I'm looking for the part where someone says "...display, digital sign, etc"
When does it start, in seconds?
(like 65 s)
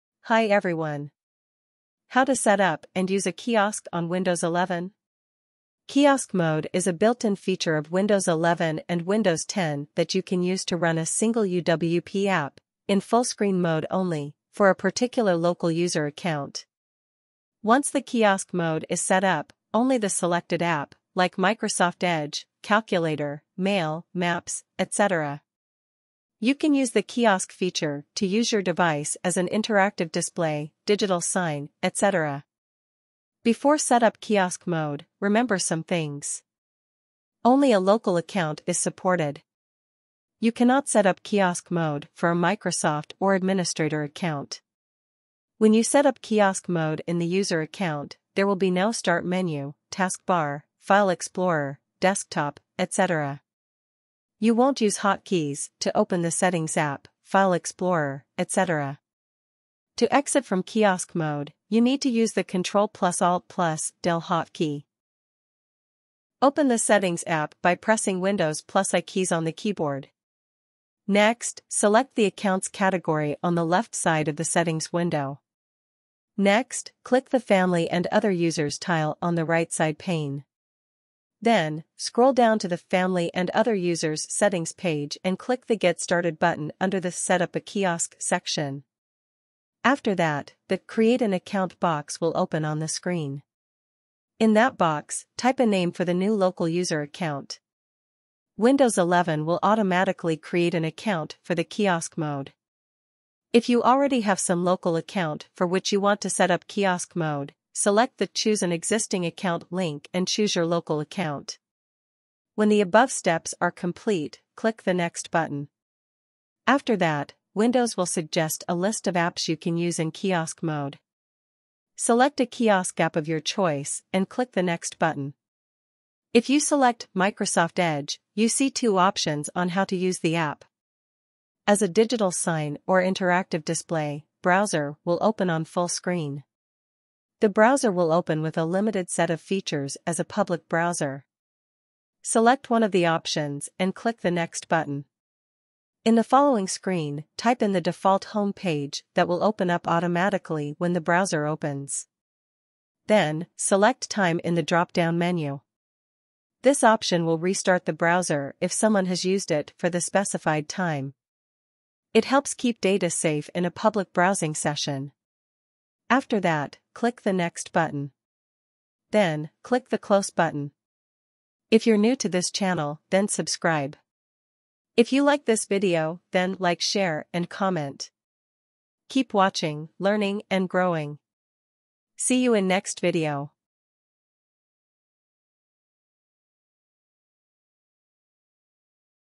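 30 s.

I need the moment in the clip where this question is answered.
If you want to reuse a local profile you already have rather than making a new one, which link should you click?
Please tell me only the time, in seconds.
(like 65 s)
108 s.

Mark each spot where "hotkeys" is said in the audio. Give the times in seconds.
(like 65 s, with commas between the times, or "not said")
54 s, 64 s.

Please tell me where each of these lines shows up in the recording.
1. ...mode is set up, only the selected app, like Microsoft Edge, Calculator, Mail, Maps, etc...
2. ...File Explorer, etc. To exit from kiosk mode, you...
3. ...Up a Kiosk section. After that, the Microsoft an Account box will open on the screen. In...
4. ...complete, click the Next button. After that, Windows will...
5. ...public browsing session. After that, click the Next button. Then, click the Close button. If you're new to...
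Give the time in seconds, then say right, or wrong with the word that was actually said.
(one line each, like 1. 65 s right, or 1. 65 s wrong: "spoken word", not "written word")
1. 18 s right
2. 57 s right
3. 87 s wrong: "Create", not "Microsoft"
4. 113 s right
5. 163 s right.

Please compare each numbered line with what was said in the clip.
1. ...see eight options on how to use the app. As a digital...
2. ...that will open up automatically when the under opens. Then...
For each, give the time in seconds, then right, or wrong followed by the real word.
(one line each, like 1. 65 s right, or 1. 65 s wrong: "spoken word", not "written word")
1. 128 s wrong: "two", not "eight"
2. 149 s wrong: "browser", not "under".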